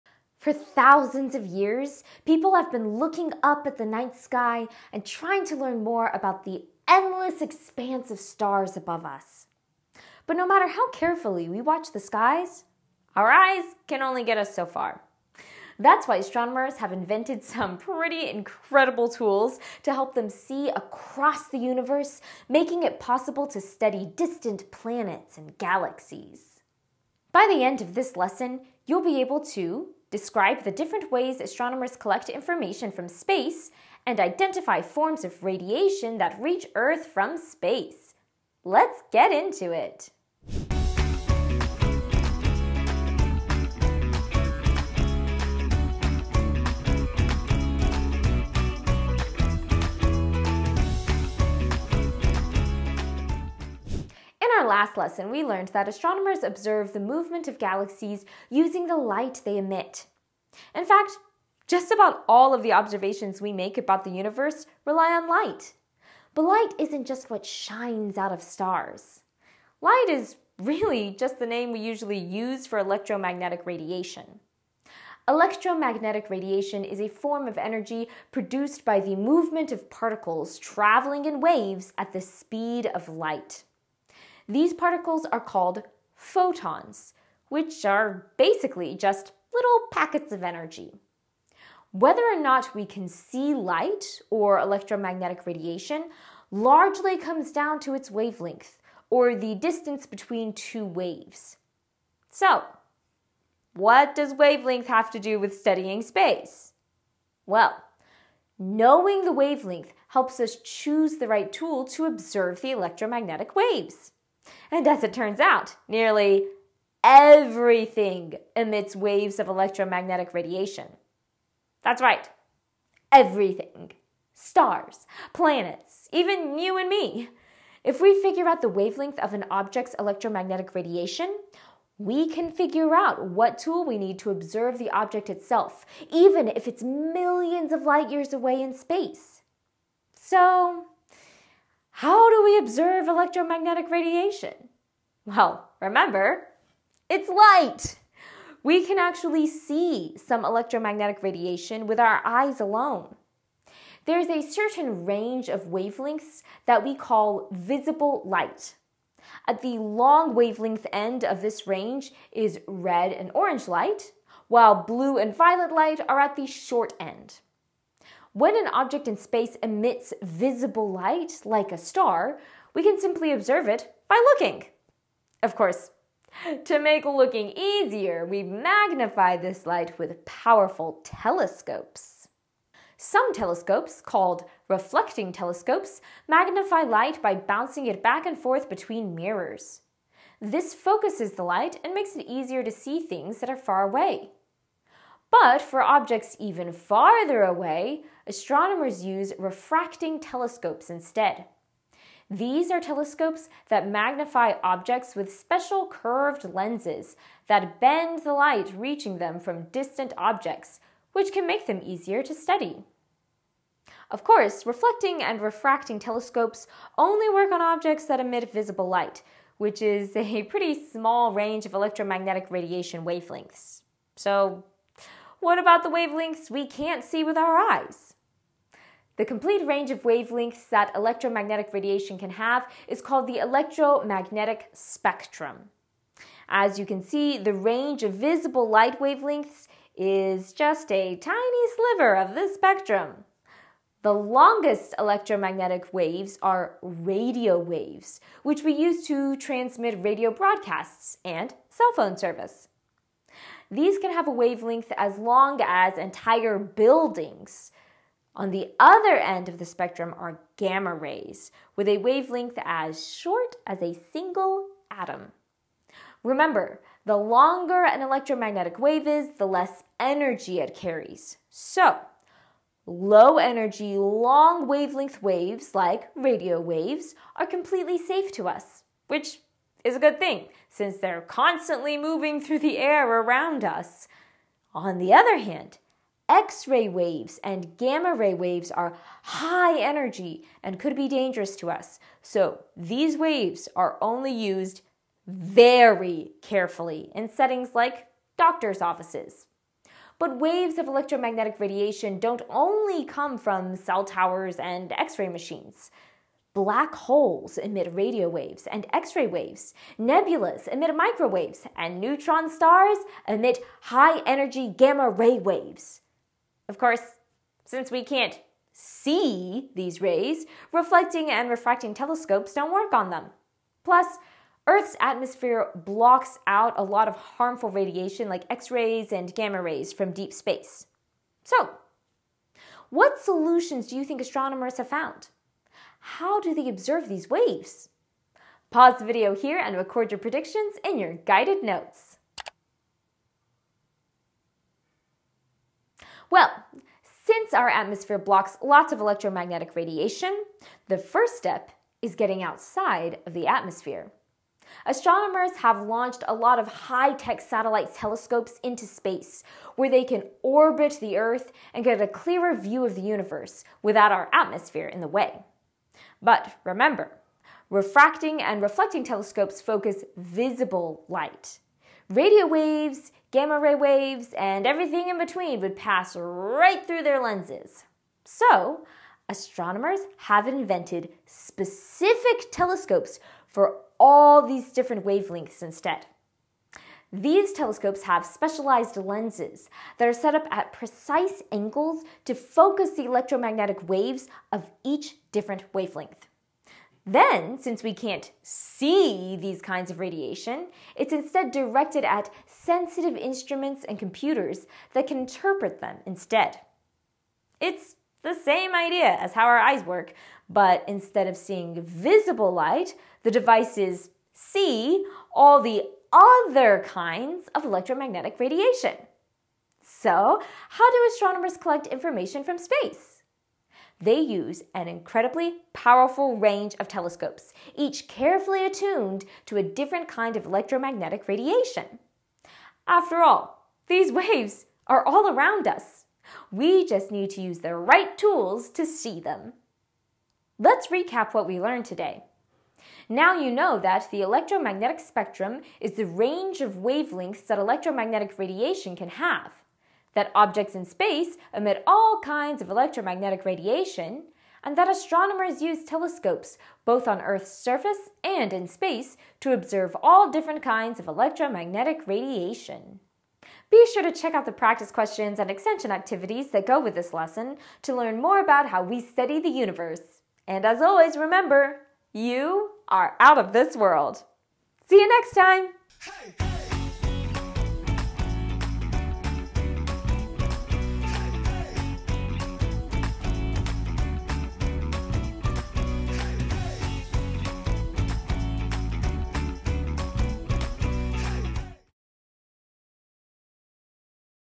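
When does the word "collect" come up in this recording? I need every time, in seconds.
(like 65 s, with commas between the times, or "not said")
31 s, 421 s.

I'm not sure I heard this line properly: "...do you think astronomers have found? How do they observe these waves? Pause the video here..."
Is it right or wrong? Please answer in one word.
right.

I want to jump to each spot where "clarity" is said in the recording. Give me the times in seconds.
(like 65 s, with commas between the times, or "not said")
not said.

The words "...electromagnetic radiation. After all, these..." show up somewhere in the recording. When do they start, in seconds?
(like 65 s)
430 s.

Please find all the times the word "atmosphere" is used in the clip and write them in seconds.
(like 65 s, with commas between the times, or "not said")
324 s, 347 s, 353 s, 364 s.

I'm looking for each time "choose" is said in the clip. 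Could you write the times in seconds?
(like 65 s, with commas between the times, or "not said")
110 s.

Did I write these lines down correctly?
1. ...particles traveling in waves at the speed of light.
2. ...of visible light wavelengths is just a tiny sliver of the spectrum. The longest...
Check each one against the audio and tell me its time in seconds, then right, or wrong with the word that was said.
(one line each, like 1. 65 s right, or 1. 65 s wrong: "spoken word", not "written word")
1. 79 s right
2. 238 s right.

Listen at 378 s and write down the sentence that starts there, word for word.
So, astronomers have invented specific telescopes for all these different wavelengths instead.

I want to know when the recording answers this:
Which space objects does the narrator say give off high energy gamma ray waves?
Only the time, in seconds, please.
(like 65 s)
312 s.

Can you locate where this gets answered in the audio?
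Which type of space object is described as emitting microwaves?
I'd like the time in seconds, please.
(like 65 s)
309 s.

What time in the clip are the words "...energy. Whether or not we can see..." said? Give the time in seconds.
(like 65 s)
90 s.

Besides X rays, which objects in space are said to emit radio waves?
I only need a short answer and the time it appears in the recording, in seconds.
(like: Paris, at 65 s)
Black holes, at 306 s.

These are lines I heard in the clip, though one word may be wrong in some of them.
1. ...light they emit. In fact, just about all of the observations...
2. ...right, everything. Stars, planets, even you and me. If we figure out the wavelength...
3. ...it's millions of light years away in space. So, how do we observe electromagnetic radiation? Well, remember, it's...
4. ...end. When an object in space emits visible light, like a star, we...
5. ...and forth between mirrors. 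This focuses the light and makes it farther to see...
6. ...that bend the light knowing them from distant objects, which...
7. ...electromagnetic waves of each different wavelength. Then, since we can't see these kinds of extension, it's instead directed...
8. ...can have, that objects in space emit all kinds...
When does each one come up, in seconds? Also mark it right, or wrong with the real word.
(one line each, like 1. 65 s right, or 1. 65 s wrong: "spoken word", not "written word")
1. 58 s right
2. 122 s right
3. 136 s right
4. 166 s right
5. 188 s wrong: "easier", not "farther"
6. 207 s wrong: "reaching", not "knowing"
7. 393 s wrong: "radiation", not "extension"
8. 448 s right.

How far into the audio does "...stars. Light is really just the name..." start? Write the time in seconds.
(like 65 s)
68 s.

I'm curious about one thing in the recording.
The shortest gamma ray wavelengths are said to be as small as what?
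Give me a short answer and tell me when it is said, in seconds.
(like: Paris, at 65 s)
A single atom, at 263 s.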